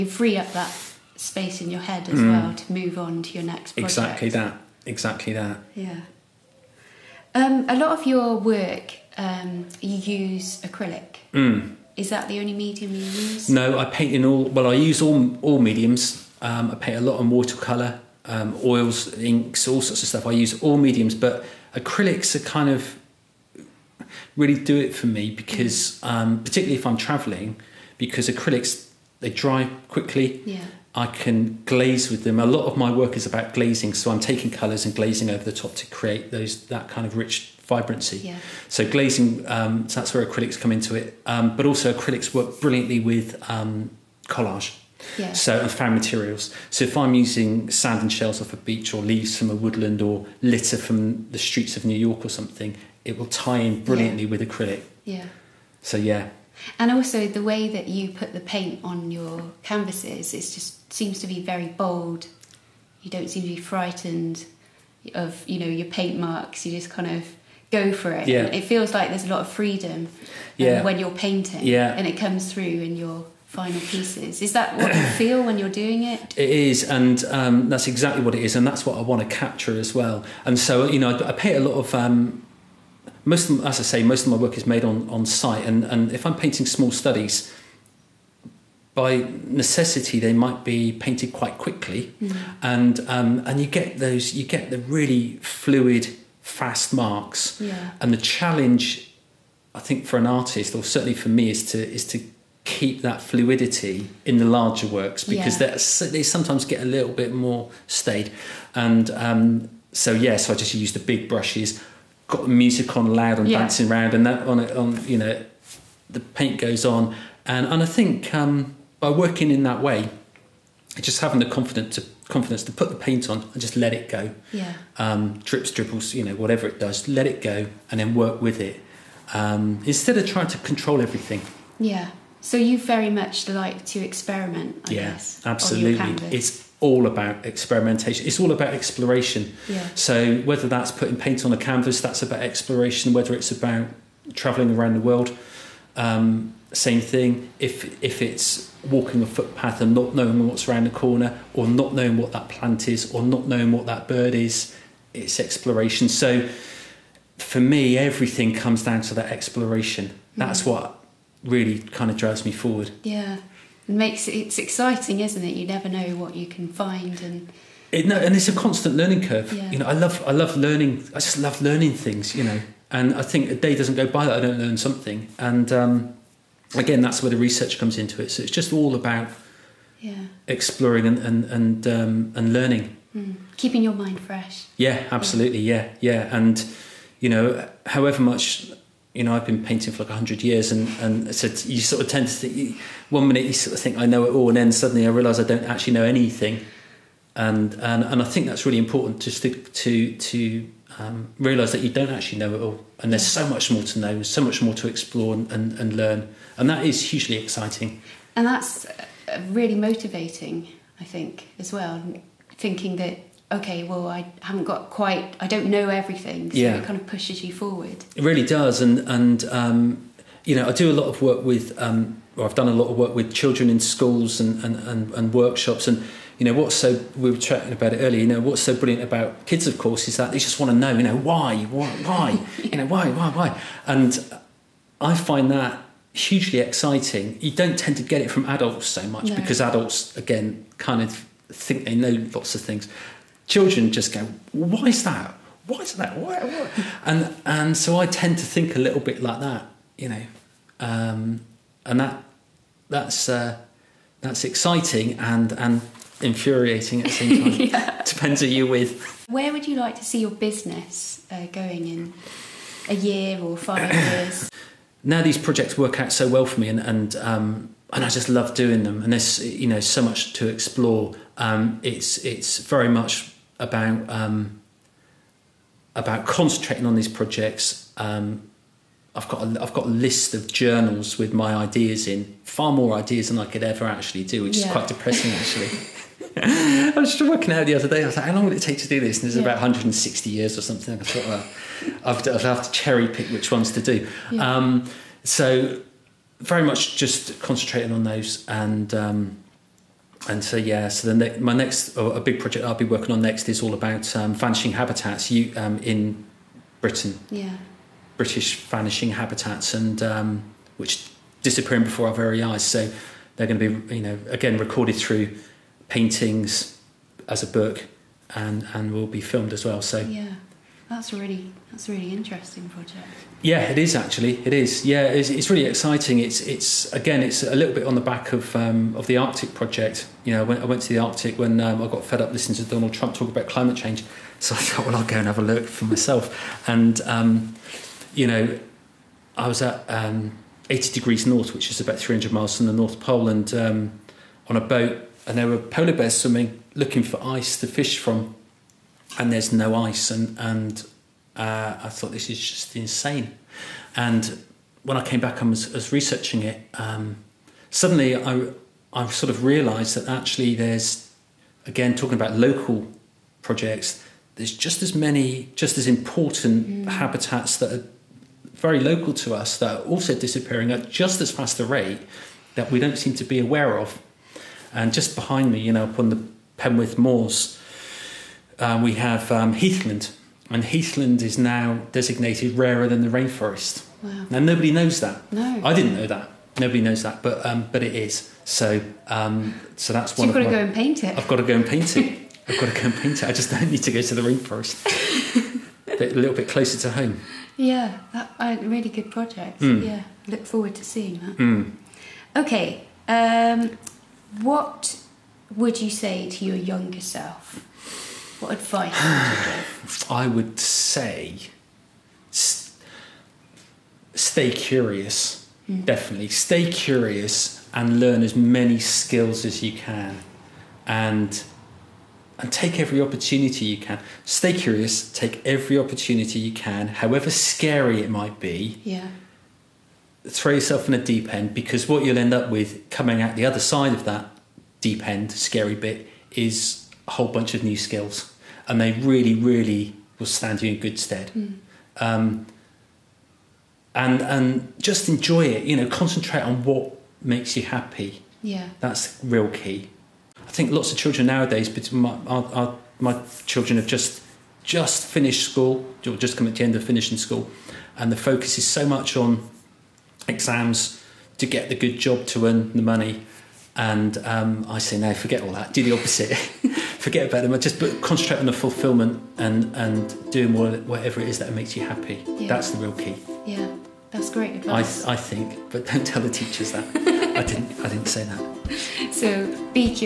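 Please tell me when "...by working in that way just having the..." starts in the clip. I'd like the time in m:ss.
1:58.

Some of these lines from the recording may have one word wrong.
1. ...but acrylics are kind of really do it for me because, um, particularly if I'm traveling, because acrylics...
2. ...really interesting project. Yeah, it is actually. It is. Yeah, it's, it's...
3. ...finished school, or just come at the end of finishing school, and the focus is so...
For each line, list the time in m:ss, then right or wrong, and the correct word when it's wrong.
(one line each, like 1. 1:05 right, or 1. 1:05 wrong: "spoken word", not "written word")
1. 0:21 right
2. 5:21 right
3. 7:35 right.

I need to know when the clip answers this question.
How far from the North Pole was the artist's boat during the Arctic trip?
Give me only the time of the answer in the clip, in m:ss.
5:41.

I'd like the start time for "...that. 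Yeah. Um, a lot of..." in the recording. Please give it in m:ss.
0:05.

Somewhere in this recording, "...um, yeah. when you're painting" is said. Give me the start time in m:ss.
1:10.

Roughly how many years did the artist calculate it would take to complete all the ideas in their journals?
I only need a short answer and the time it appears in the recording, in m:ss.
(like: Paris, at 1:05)
160, at 4:49.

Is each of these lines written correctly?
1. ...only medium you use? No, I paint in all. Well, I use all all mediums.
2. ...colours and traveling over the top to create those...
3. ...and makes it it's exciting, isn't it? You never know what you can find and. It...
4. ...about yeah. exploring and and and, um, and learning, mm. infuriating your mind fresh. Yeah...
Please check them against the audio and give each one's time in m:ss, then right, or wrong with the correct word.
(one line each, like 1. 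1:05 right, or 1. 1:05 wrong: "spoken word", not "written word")
1. 0:12 right
2. 0:34 wrong: "glazing", not "traveling"
3. 2:43 right
4. 2:58 wrong: "keeping", not "infuriating".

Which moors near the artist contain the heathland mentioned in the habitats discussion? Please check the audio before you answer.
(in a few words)
Penwith Moors.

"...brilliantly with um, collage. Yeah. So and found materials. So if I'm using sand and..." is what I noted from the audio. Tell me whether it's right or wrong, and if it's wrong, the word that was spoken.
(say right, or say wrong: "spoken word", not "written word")
right.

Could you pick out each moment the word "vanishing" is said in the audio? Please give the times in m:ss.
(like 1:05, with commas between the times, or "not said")
5:04, 5:08.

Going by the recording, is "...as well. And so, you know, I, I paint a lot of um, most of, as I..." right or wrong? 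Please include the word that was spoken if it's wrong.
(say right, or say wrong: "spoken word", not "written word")
right.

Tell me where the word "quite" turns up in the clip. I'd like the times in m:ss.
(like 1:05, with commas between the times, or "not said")
1:31, 3:34, 4:44.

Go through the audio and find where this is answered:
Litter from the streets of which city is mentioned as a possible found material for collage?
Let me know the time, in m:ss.
0:51.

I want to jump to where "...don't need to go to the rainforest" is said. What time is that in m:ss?
6:33.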